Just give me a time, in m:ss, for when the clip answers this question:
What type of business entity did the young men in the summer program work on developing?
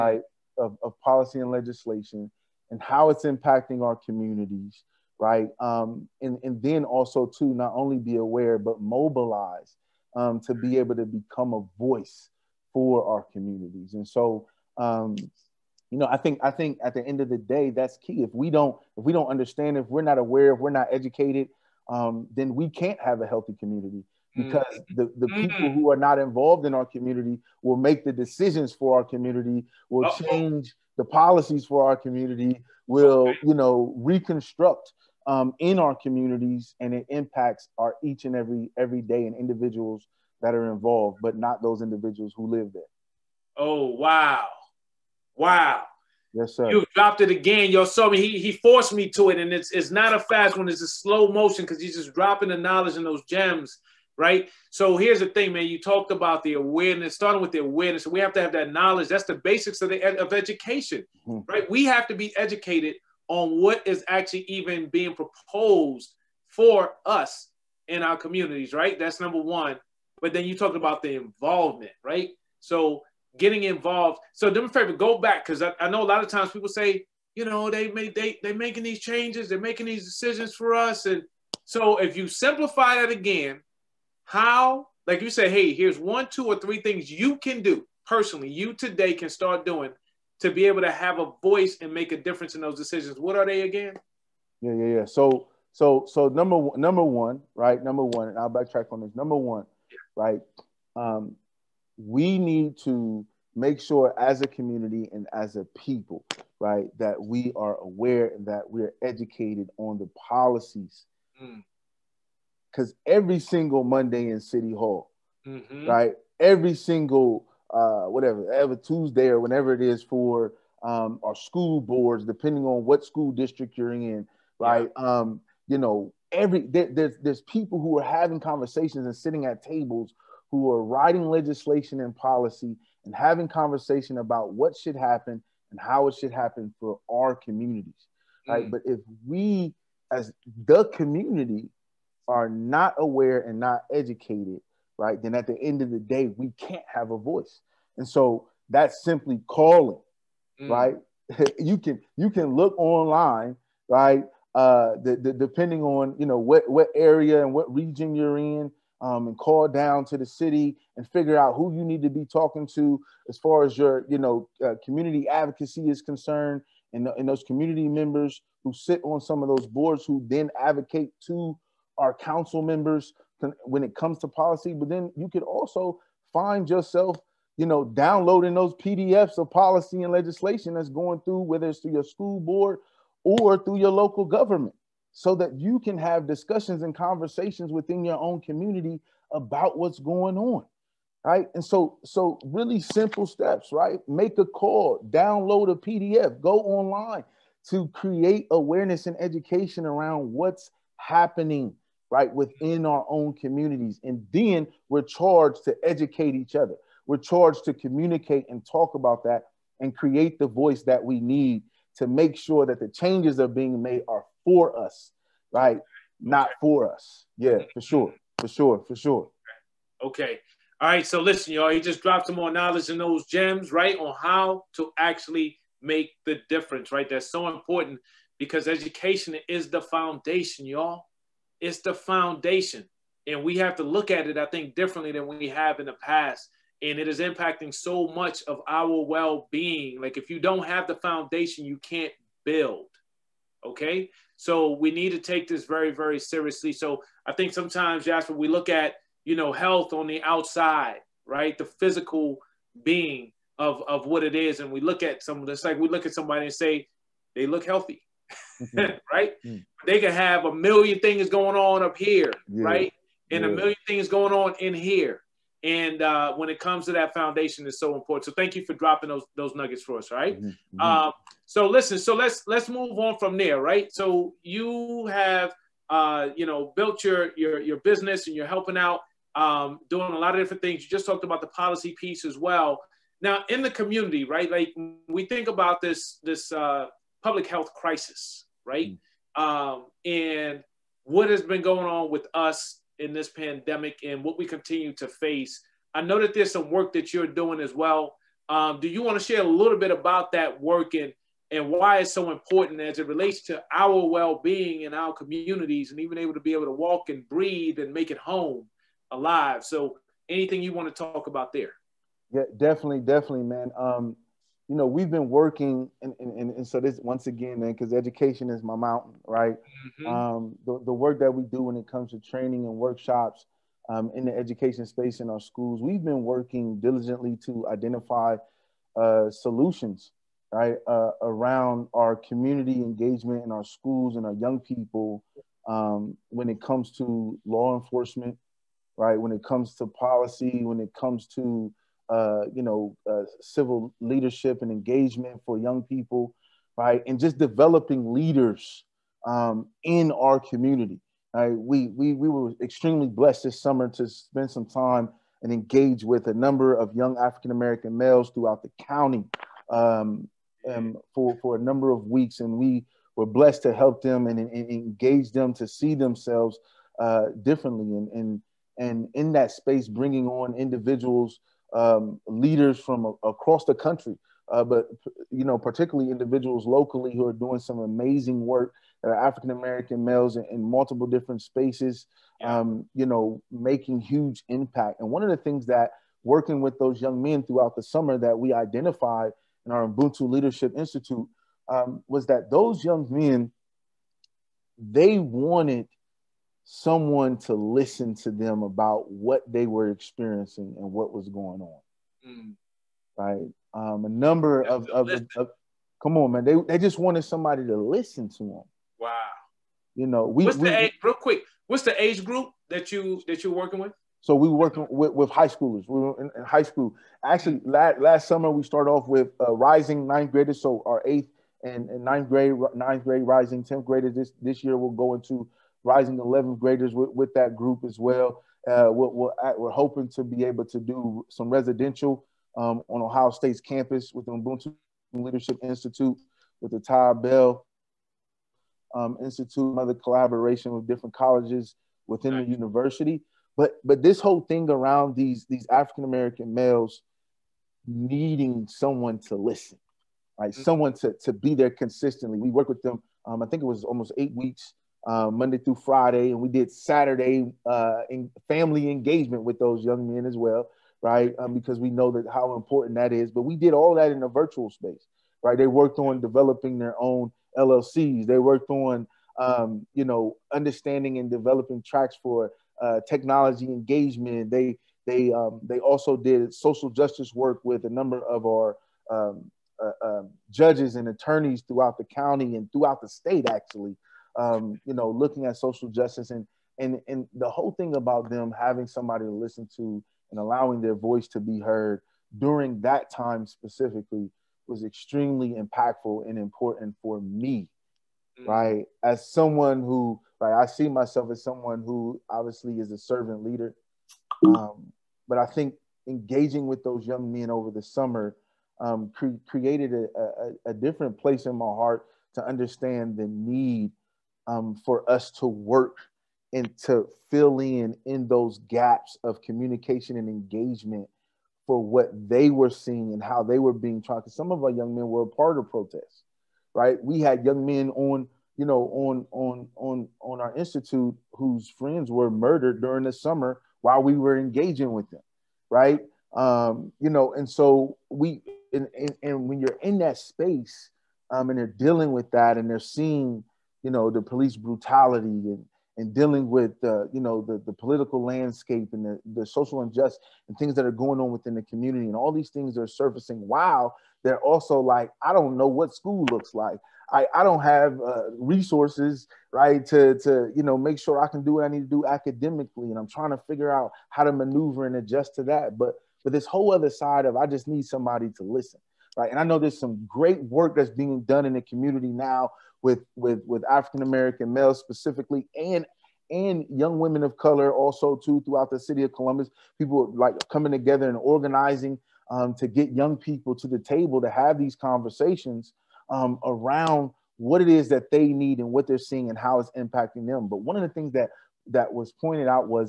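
7:47.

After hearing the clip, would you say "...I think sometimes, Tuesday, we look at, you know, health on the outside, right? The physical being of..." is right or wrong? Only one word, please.
wrong.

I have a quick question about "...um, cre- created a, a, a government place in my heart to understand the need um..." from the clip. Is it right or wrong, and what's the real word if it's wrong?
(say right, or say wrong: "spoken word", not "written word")
wrong: "different", not "government".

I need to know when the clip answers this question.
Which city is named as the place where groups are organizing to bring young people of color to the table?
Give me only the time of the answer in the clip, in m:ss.
9:38.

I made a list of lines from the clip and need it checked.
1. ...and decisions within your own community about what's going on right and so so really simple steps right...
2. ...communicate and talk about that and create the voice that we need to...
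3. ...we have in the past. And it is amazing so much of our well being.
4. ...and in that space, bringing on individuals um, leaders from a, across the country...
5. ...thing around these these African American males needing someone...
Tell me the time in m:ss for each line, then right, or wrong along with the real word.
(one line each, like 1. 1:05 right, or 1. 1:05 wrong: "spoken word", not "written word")
1. 3:06 wrong: "conversations", not "decisions"
2. 3:27 right
3. 3:55 wrong: "impacting", not "amazing"
4. 6:08 right
5. 7:24 right.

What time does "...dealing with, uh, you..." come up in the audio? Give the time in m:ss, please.
9:06.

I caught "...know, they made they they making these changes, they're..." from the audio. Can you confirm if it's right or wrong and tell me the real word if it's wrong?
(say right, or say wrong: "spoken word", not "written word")
right.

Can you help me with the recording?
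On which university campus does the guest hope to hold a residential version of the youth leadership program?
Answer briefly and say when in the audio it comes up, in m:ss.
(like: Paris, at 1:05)
Ohio State, at 7:13.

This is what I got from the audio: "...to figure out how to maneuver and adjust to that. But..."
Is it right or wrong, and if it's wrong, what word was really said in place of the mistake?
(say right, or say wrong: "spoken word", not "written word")
right.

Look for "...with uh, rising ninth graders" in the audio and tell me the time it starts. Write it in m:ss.
6:59.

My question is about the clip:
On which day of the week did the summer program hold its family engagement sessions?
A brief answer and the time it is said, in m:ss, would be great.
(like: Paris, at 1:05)
Saturday, at 7:36.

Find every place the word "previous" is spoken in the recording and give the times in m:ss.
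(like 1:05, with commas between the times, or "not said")
not said.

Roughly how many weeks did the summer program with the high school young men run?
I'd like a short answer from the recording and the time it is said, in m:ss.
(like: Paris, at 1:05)
8, at 7:33.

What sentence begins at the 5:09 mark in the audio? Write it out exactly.
So anything you want to talk about there?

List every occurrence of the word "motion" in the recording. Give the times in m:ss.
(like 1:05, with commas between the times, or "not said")
0:51.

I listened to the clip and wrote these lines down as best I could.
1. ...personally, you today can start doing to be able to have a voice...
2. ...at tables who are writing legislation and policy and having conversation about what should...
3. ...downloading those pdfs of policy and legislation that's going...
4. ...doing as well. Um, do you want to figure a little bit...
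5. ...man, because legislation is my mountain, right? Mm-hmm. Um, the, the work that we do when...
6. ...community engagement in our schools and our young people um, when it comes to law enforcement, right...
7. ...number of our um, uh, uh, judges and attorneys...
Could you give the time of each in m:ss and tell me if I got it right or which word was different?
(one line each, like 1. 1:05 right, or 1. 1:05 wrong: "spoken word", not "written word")
1. 1:28 right
2. 2:09 right
3. 2:57 right
4. 4:57 wrong: "share", not "figure"
5. 5:17 wrong: "education", not "legislation"
6. 5:32 right
7. 7:57 right.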